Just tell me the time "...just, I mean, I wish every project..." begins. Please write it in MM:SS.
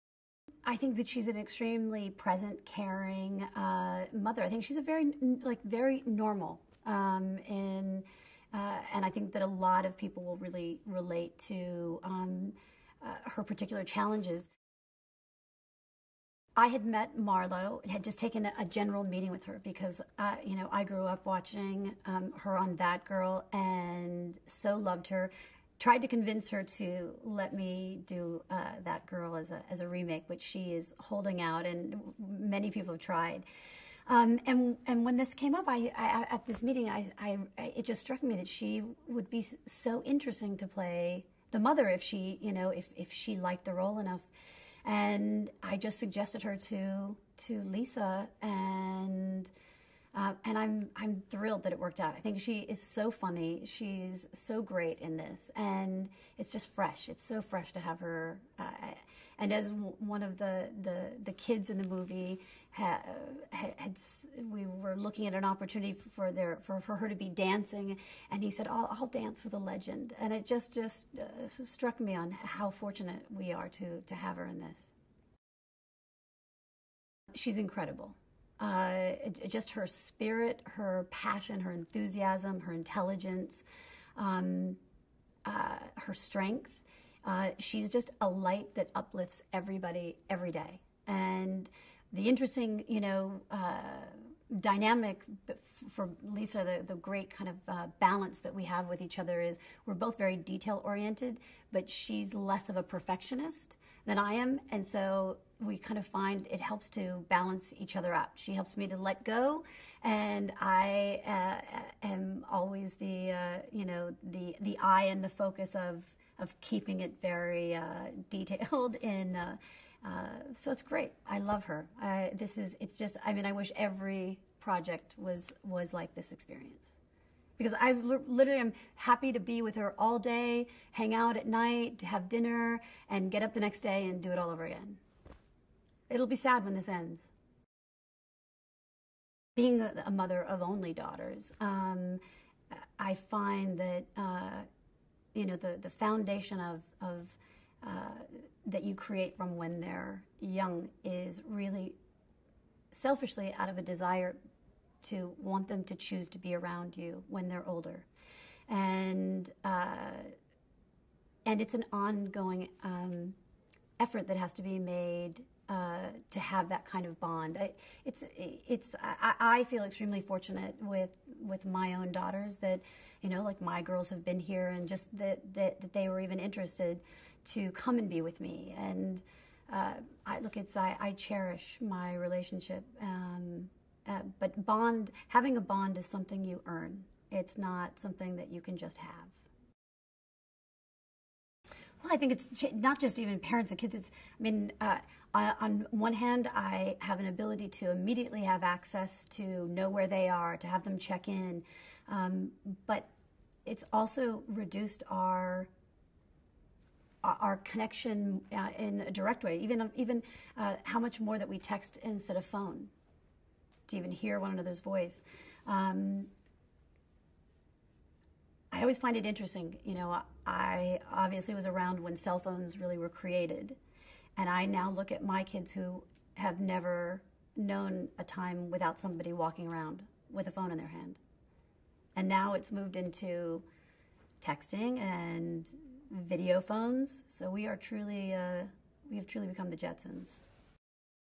02:02.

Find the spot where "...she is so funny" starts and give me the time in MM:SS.
00:52.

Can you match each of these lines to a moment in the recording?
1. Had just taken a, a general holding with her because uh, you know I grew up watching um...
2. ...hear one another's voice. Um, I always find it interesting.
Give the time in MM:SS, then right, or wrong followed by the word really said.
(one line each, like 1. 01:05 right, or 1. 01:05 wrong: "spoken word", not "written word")
1. 00:17 wrong: "meeting", not "holding"
2. 03:34 right.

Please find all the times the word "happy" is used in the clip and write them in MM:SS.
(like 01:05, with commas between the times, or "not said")
02:08.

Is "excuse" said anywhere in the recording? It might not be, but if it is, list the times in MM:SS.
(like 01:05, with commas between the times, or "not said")
not said.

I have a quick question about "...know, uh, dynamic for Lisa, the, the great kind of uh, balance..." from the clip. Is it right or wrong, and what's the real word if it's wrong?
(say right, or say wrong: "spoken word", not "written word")
right.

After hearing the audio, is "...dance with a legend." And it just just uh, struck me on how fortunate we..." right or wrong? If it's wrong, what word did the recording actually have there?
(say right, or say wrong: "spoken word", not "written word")
right.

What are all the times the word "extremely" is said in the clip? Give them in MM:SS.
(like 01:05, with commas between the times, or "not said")
00:01, 02:49.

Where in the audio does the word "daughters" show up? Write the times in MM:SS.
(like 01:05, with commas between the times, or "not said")
02:20, 02:52.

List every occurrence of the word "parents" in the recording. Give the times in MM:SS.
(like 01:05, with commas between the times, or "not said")
03:13.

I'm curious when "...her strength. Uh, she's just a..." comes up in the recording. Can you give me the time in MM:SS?
01:25.